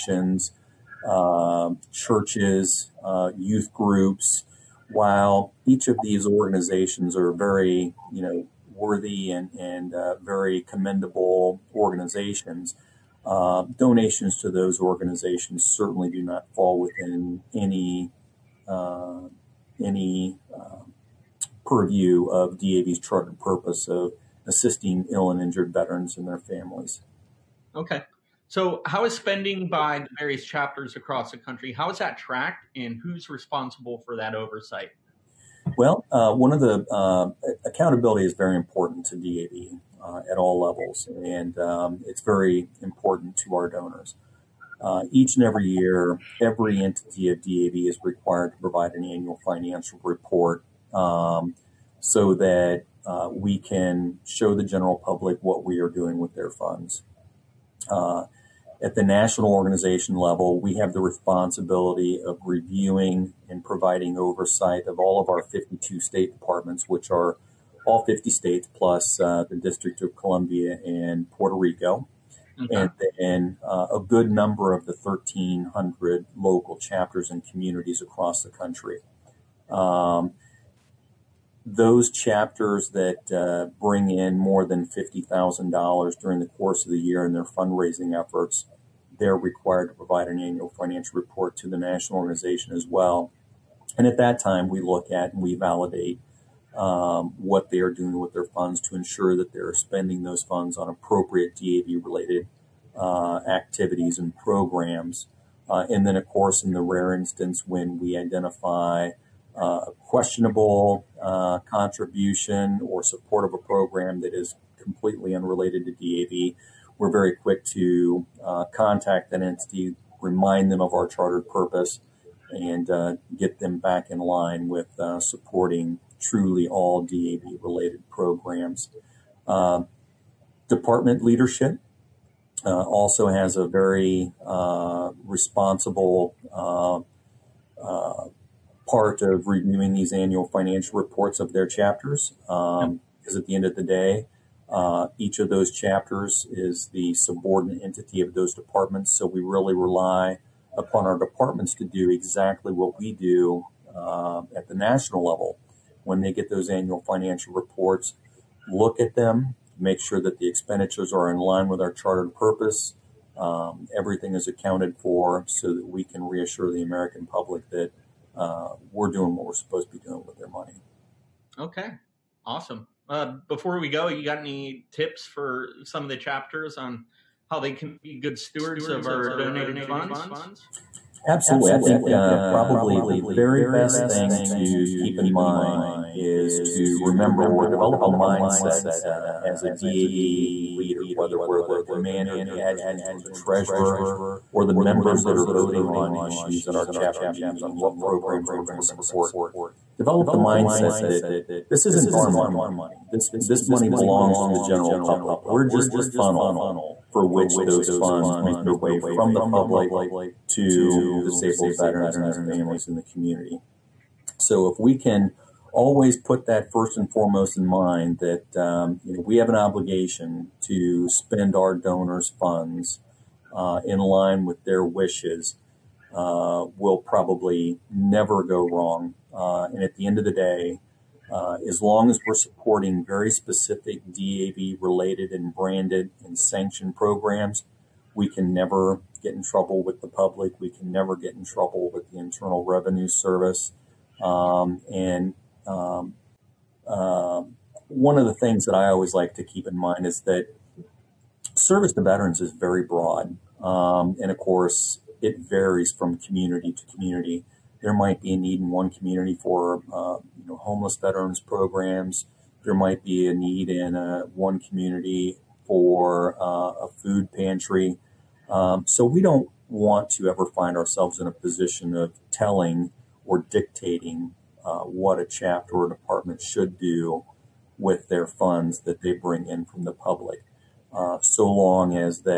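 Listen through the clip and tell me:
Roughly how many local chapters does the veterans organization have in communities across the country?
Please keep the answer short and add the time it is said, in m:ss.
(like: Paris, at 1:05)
1,300, at 1:15.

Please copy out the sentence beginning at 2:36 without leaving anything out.
When they get those annual financial reports, look at them, make sure that the expenditures are in line with our chartered purpose.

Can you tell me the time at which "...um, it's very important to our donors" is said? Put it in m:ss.
0:41.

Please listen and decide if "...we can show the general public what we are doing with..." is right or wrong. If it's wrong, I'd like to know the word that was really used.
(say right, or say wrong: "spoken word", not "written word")
right.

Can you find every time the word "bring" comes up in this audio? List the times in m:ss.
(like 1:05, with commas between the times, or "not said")
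1:23, 4:39.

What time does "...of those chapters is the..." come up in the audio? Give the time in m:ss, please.
2:25.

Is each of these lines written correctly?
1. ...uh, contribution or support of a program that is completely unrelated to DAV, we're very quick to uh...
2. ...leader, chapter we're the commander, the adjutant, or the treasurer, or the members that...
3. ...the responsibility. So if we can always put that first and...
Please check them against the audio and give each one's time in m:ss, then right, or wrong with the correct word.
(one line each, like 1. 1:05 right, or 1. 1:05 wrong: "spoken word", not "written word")
1. 1:51 right
2. 3:10 wrong: "whether", not "chapter"
3. 3:32 wrong: "community", not "responsibility".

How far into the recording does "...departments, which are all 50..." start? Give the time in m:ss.
1:06.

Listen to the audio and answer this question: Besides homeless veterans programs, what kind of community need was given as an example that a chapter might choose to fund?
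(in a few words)
food pantry.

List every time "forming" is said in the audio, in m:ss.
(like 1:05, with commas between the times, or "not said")
not said.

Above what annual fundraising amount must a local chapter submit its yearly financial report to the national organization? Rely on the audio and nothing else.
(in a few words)
$50,000.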